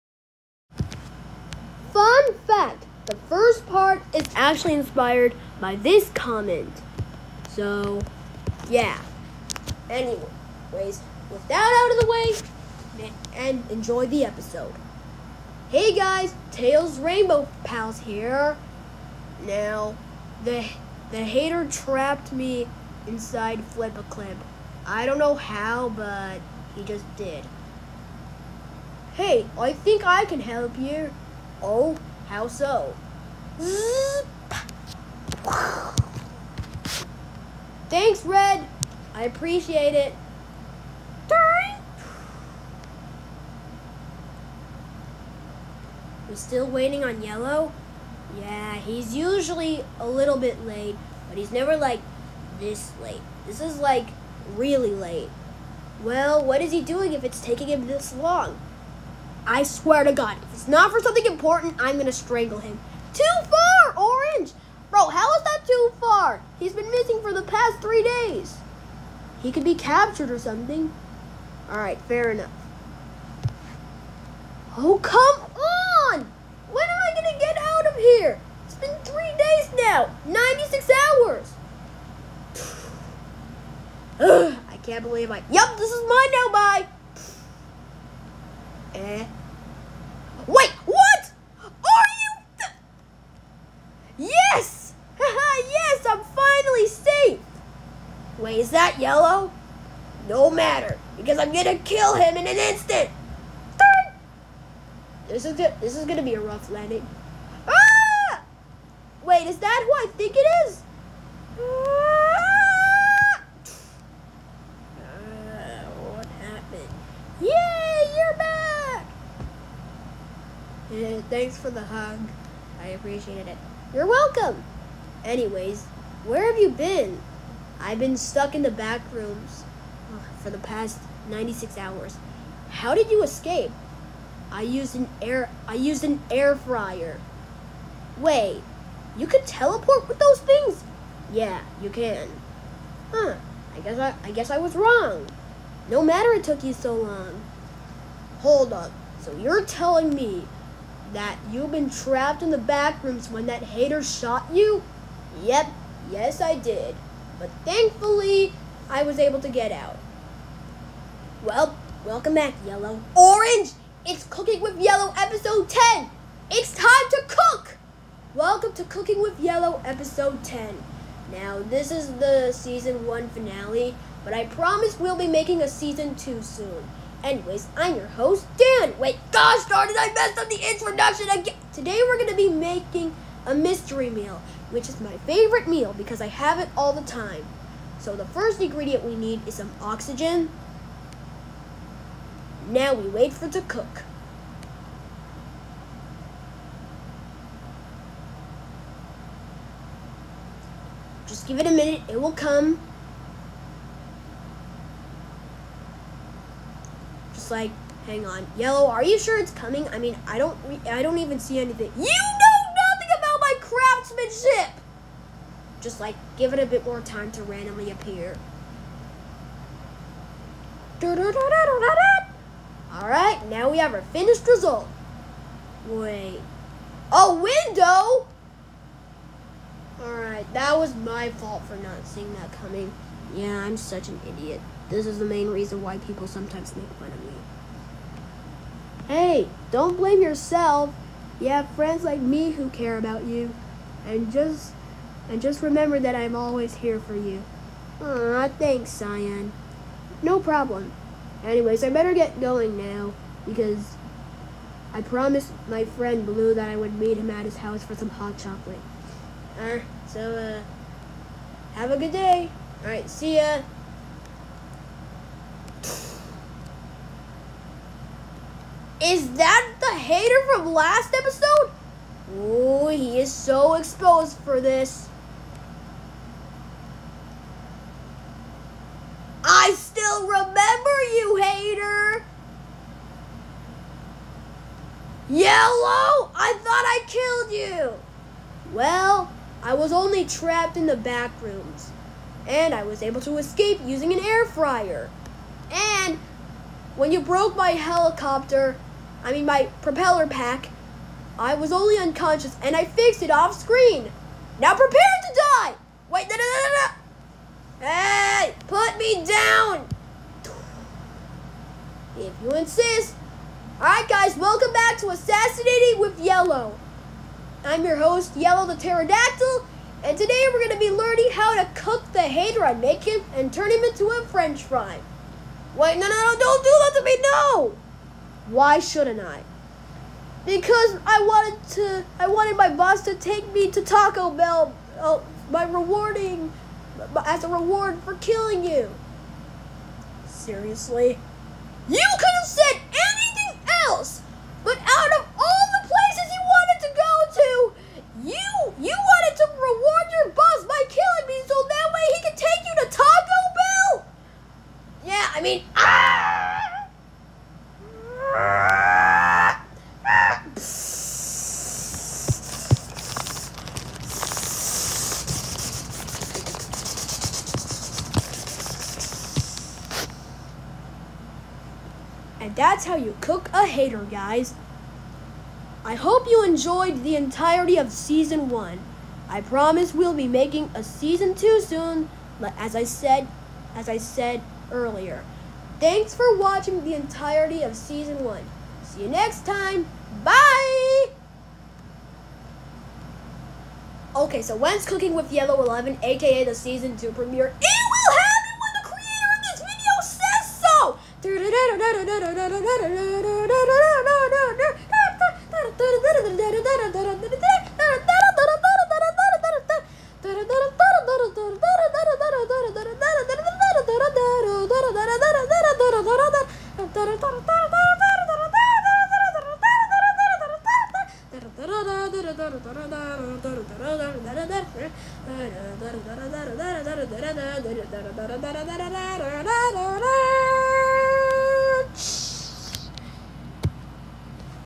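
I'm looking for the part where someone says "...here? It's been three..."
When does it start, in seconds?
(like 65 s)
77 s.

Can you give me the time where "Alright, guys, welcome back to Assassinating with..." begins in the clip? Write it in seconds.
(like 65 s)
313 s.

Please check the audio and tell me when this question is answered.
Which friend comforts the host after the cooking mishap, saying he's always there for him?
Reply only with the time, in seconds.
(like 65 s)
248 s.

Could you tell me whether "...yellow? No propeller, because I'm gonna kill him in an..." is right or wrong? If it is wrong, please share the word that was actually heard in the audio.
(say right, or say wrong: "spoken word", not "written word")
wrong: "matter", not "propeller".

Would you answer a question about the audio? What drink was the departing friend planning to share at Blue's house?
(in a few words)
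hot chocolate.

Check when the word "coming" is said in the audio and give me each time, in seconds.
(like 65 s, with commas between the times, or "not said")
209 s, 232 s.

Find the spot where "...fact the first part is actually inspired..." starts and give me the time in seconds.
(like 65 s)
2 s.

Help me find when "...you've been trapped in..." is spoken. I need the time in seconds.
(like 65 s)
151 s.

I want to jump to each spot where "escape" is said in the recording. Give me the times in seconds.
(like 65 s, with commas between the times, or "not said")
133 s, 293 s.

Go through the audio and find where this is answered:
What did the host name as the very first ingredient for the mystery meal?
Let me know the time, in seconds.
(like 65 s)
189 s.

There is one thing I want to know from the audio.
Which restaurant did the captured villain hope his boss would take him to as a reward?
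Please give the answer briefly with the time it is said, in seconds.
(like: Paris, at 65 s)
Taco Bell, at 333 s.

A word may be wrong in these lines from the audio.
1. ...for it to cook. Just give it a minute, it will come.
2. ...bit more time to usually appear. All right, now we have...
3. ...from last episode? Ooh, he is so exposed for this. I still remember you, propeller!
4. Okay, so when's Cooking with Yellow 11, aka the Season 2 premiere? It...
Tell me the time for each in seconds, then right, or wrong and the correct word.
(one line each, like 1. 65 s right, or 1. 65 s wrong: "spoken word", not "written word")
1. 193 s right
2. 216 s wrong: "randomly", not "usually"
3. 270 s wrong: "hater", not "propeller"
4. 394 s right.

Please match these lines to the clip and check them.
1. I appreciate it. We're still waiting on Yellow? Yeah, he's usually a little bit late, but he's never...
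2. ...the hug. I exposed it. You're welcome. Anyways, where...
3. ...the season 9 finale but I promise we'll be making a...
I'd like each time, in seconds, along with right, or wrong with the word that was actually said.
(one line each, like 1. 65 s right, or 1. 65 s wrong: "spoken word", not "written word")
1. 39 s right
2. 121 s wrong: "appreciated", not "exposed"
3. 172 s wrong: "1", not "9".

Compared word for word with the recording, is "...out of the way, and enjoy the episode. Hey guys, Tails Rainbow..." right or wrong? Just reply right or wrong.
right.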